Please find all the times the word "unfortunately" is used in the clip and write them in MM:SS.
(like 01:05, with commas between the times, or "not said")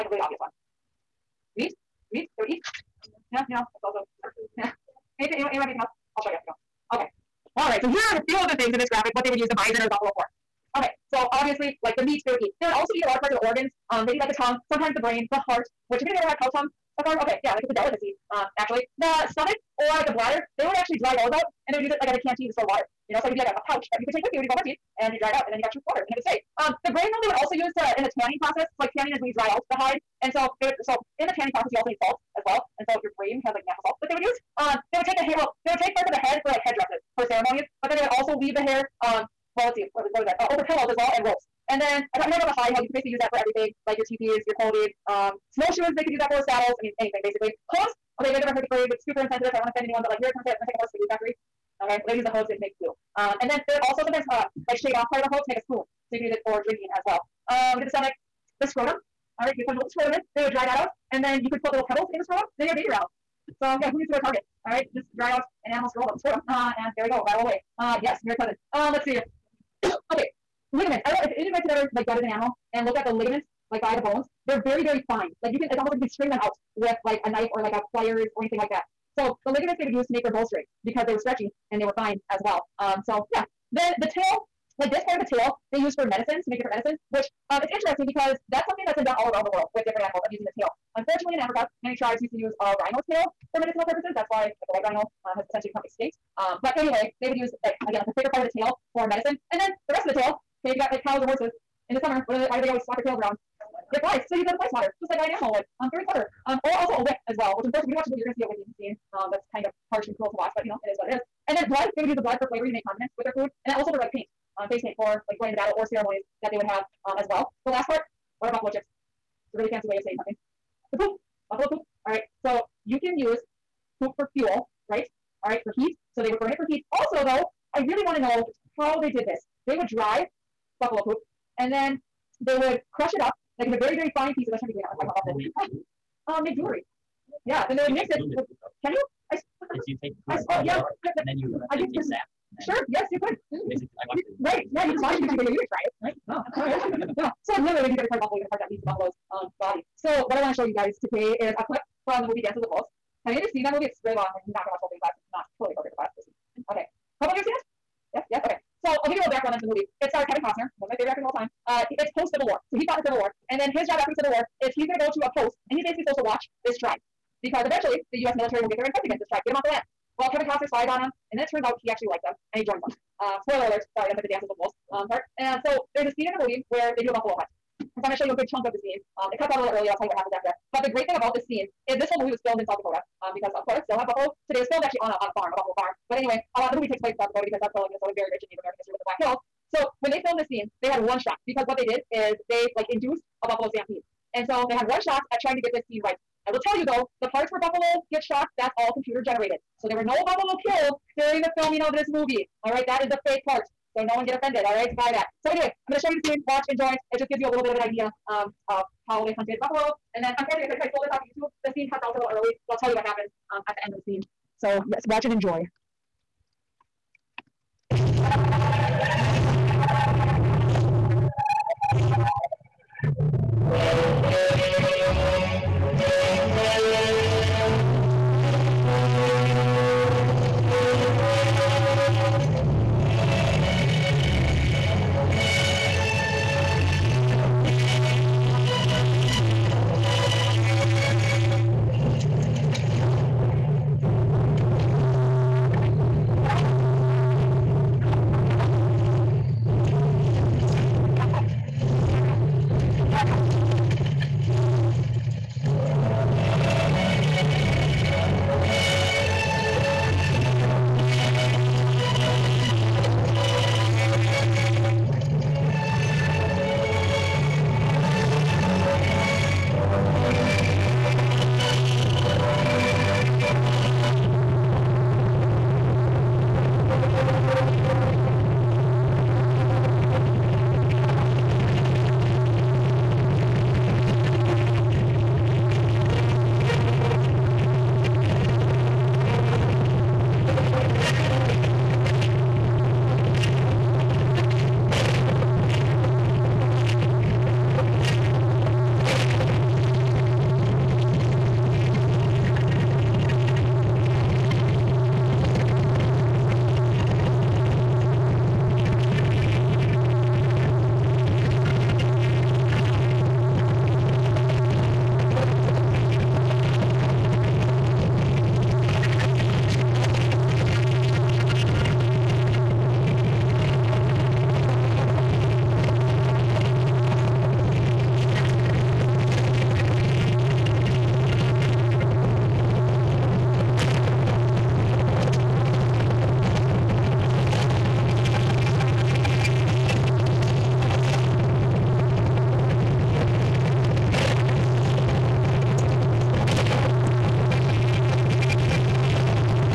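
01:30, 01:47, 03:30.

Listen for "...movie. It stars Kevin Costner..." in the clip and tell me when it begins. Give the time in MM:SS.
02:39.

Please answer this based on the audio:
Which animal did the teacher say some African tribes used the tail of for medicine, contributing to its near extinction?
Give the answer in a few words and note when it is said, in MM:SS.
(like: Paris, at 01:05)
White rhino, at 01:34.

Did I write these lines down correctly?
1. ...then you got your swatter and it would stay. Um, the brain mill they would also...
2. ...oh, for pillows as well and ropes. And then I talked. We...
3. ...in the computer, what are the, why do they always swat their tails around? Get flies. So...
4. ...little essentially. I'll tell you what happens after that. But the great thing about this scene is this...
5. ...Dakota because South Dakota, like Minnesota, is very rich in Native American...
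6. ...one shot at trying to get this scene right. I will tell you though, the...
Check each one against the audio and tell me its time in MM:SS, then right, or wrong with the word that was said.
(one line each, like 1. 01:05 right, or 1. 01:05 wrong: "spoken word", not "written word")
1. 00:25 wrong: "water", not "swatter"
2. 00:40 right
3. 01:41 wrong: "summer", not "computer"
4. 02:59 wrong: "early", not "essentially"
5. 03:07 right
6. 03:14 right.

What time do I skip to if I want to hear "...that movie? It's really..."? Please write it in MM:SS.
02:33.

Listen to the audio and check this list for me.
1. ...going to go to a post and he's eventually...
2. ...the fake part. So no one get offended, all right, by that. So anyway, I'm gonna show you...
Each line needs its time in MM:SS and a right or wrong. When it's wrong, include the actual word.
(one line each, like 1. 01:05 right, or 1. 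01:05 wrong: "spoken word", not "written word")
1. 02:44 wrong: "basically", not "eventually"
2. 03:23 right.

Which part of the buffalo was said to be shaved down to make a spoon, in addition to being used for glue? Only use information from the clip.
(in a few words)
Hoof.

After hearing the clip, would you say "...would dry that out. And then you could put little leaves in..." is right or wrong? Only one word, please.
wrong.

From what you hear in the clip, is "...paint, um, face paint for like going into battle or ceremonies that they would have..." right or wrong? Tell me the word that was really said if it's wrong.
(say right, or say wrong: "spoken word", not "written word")
right.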